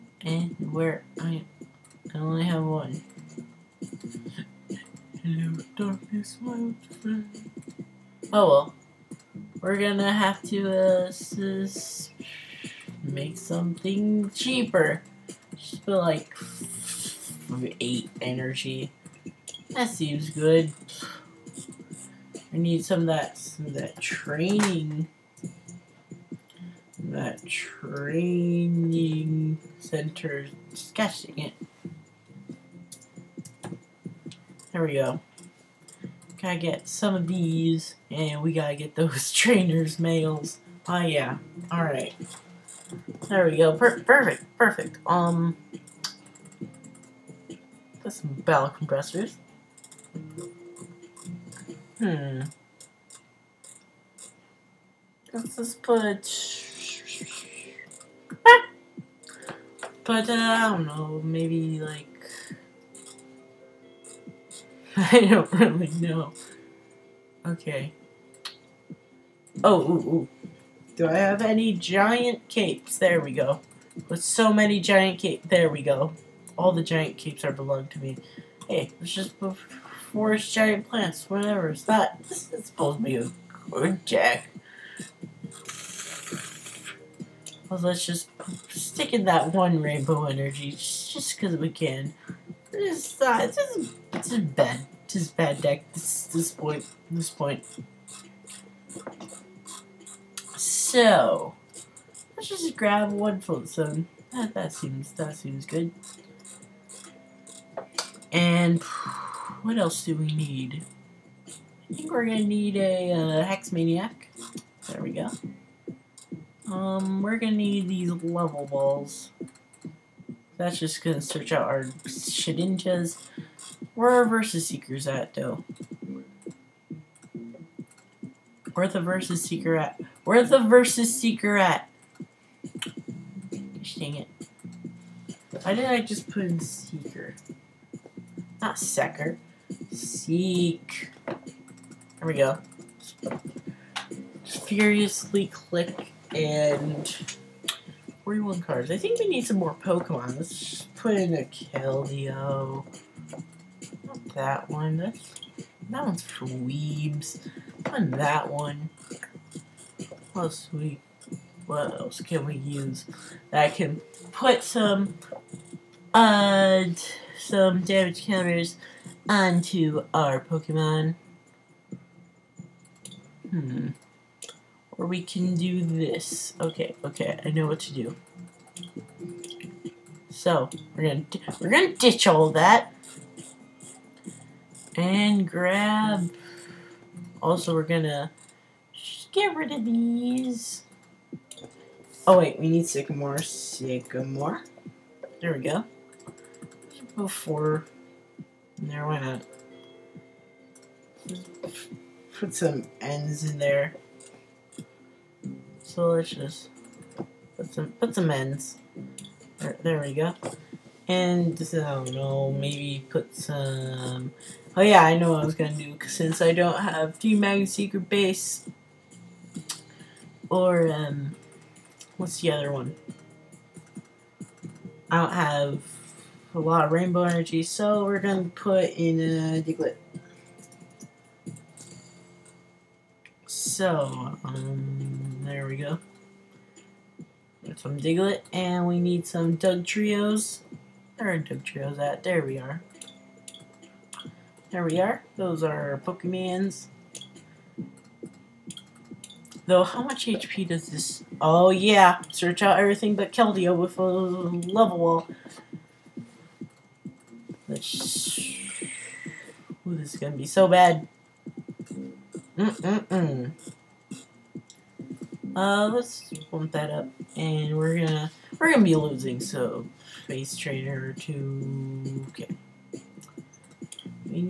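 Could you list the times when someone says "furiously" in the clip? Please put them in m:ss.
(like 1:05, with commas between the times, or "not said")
2:24.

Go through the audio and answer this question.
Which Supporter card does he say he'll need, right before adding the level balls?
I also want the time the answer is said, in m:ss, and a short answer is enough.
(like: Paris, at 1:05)
Hex Maniac, at 1:53.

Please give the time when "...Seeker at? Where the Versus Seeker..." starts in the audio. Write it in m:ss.
2:09.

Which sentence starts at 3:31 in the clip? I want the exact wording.
And this is, I don't know, maybe put some.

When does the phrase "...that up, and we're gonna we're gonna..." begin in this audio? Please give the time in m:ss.
4:26.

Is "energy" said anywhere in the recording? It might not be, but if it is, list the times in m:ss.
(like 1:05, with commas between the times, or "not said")
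0:18, 1:30, 3:47.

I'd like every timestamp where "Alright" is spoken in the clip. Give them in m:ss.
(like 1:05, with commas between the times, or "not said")
0:41.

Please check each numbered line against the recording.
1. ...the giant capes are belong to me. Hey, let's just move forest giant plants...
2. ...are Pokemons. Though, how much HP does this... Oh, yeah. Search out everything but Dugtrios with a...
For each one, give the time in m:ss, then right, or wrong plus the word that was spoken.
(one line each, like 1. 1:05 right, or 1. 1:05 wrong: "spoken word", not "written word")
1. 1:16 right
2. 4:05 wrong: "Keldeo", not "Dugtrios".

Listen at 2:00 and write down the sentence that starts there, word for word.
That's just gonna search out our Shedinjas.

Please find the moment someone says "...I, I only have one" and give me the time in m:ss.
0:01.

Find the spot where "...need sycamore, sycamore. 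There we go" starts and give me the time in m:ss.
3:12.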